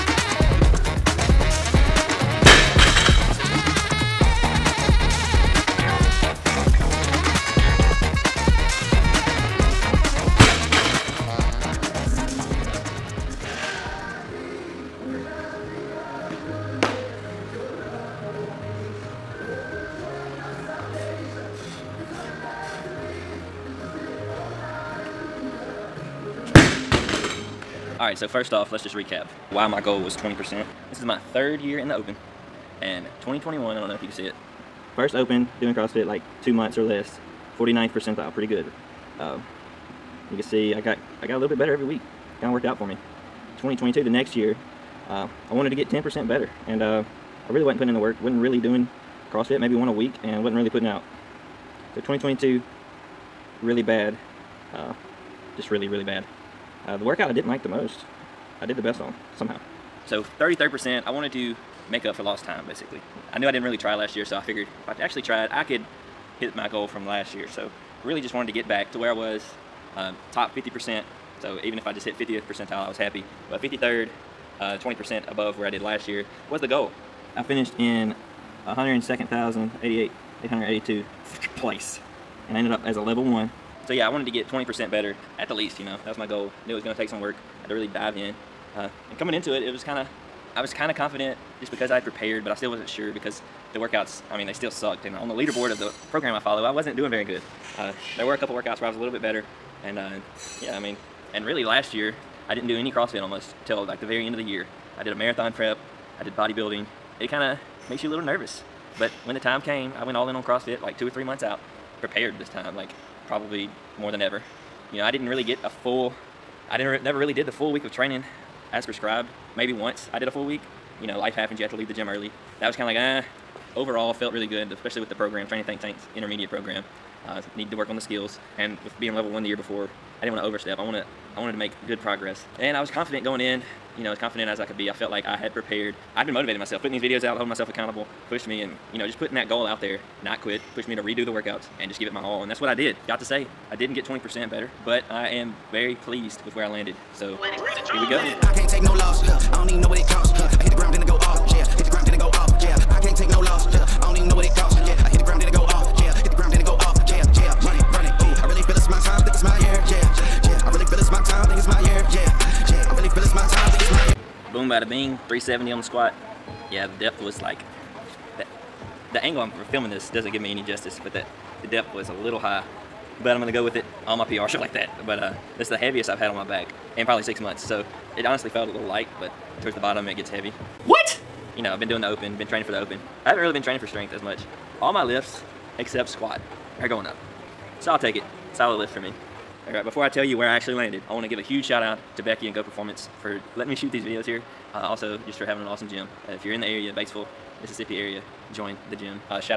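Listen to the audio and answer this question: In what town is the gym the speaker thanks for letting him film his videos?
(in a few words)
Batesville, Mississippi.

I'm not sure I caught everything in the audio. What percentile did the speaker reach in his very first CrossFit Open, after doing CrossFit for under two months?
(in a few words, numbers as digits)
49th percentile.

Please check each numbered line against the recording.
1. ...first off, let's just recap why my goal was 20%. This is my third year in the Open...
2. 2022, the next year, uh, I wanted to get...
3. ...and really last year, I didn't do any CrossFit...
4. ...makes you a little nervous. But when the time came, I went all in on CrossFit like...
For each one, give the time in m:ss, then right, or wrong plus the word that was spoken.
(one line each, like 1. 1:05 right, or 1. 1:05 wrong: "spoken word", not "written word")
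1. 0:28 right
2. 0:43 right
3. 1:41 right
4. 1:47 right.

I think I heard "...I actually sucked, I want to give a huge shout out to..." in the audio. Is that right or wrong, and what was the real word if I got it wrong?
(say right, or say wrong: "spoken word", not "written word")
wrong: "landed", not "sucked".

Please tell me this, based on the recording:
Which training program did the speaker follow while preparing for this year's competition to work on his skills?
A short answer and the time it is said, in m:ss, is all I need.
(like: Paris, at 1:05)
Training Think Tank's intermediate program, at 2:05.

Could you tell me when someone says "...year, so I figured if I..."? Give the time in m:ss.
1:04.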